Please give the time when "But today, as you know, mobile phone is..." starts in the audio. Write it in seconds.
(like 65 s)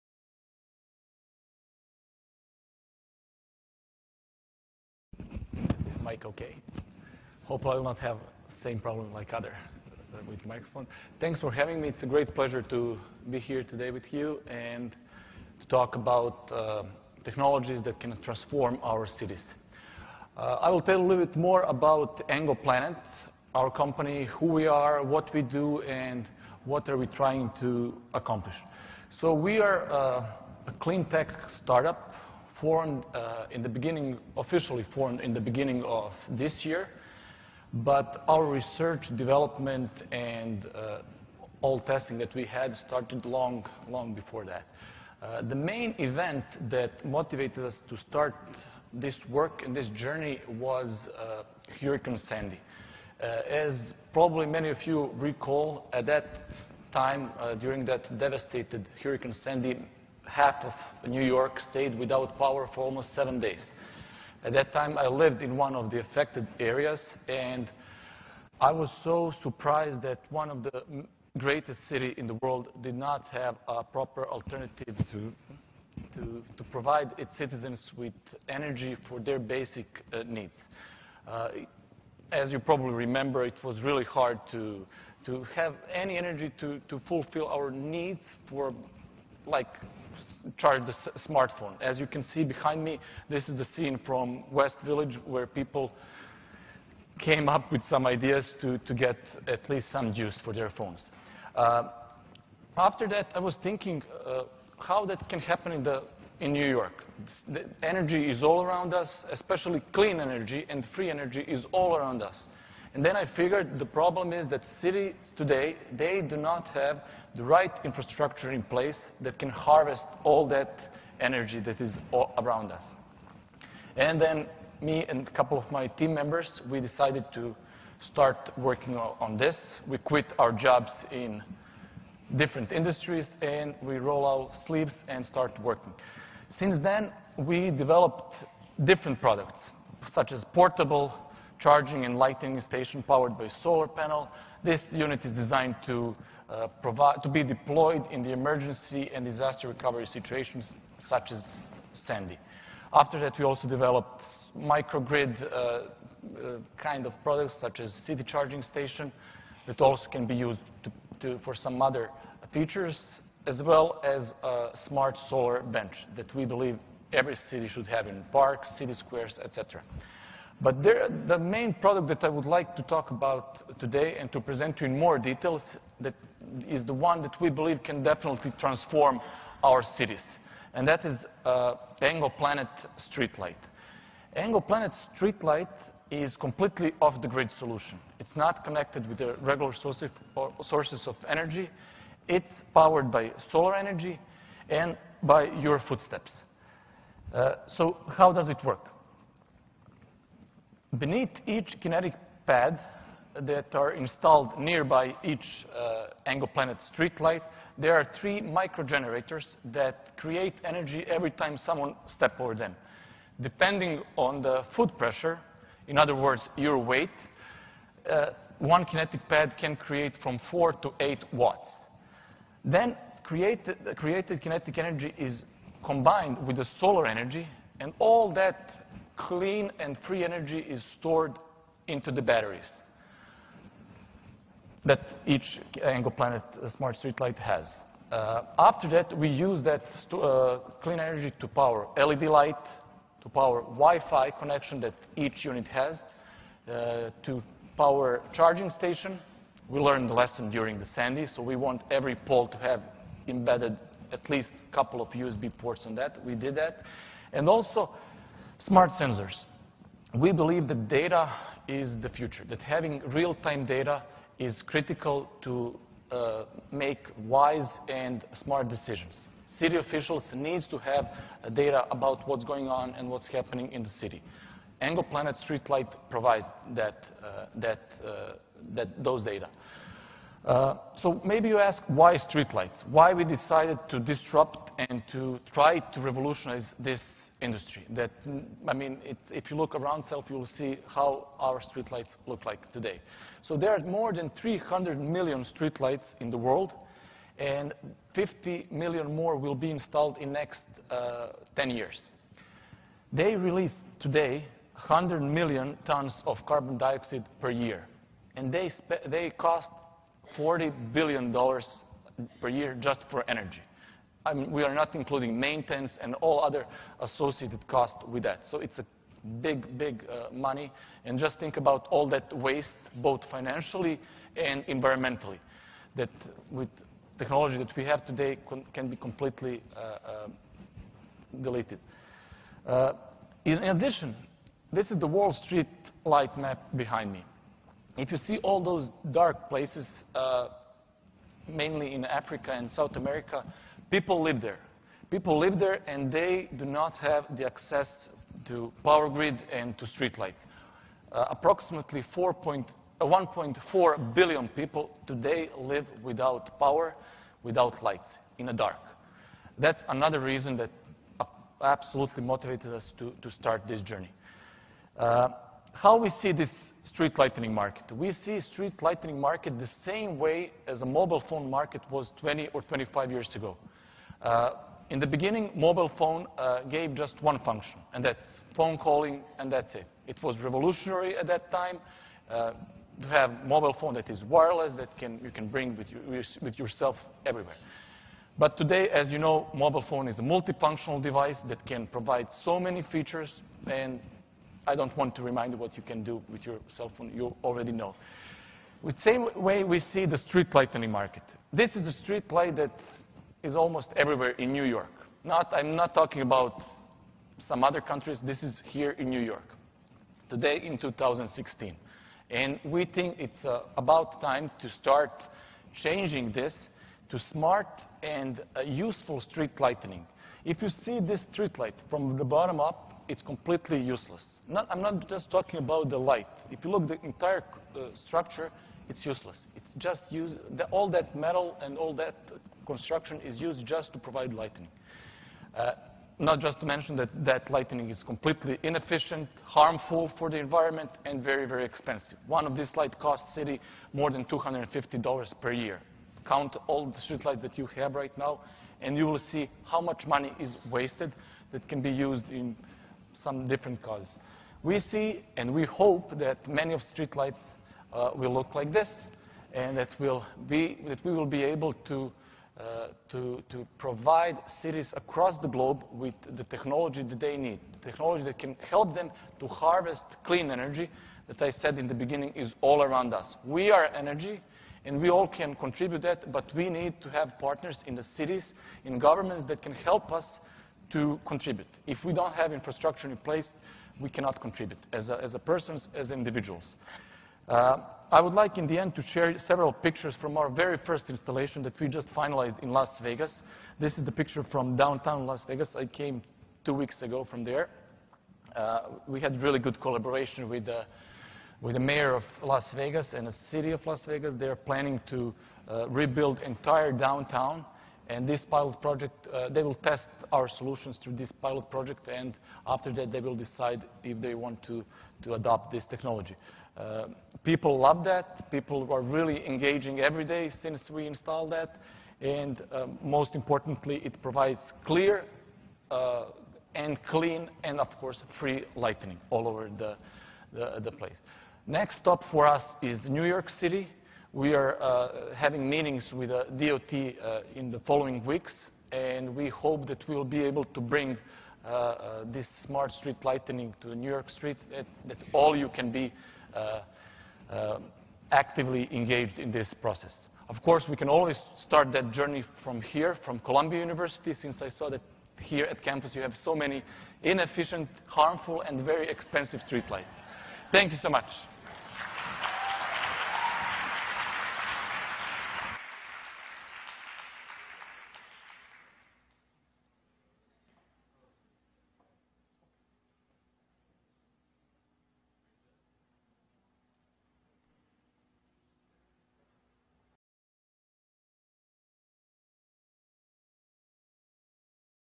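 388 s.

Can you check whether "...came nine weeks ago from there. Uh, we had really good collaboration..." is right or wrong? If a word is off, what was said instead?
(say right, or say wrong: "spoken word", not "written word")
wrong: "two", not "nine".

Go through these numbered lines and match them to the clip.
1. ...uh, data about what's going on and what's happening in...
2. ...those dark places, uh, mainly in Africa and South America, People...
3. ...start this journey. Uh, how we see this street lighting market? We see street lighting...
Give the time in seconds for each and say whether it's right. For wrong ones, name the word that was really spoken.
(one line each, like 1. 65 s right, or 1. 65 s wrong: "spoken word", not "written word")
1. 271 s right
2. 338 s right
3. 363 s right.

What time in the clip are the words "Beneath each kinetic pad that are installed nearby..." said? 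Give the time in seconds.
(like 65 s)
200 s.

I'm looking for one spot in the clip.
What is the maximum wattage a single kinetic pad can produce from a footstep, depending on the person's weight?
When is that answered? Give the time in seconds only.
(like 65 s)
220 s.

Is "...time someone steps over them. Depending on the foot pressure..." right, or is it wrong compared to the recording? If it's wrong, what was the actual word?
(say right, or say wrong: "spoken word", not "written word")
right.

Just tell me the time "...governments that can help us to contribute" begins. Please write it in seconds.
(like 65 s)
478 s.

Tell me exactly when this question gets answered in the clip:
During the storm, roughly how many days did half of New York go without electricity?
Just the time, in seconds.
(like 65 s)
63 s.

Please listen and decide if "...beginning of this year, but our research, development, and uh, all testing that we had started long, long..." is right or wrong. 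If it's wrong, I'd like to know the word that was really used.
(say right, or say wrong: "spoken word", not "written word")
right.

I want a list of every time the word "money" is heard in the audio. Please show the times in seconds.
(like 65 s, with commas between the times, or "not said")
320 s, 450 s.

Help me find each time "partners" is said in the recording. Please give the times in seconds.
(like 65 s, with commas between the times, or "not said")
477 s.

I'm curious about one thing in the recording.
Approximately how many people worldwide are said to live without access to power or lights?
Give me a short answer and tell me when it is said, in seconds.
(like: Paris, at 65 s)
1.4 billion, at 352 s.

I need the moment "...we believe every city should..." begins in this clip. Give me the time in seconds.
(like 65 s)
166 s.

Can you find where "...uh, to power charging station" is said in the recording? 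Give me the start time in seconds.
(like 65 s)
246 s.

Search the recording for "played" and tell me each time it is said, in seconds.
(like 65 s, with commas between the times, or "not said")
not said.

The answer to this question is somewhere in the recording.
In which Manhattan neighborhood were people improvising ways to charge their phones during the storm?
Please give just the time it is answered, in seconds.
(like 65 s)
94 s.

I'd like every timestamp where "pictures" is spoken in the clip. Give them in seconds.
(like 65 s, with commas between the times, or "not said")
489 s, 494 s.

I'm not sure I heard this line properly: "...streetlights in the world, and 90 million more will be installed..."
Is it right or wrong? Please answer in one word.
wrong.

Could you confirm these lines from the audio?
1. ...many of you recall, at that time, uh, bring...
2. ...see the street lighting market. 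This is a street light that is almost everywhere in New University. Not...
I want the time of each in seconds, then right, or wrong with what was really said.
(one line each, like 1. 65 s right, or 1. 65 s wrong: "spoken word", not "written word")
1. 54 s wrong: "during", not "bring"
2. 399 s wrong: "York", not "University".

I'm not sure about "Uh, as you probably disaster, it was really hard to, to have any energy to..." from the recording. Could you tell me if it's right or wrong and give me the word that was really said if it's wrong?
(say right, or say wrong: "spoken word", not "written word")
wrong: "remember", not "disaster".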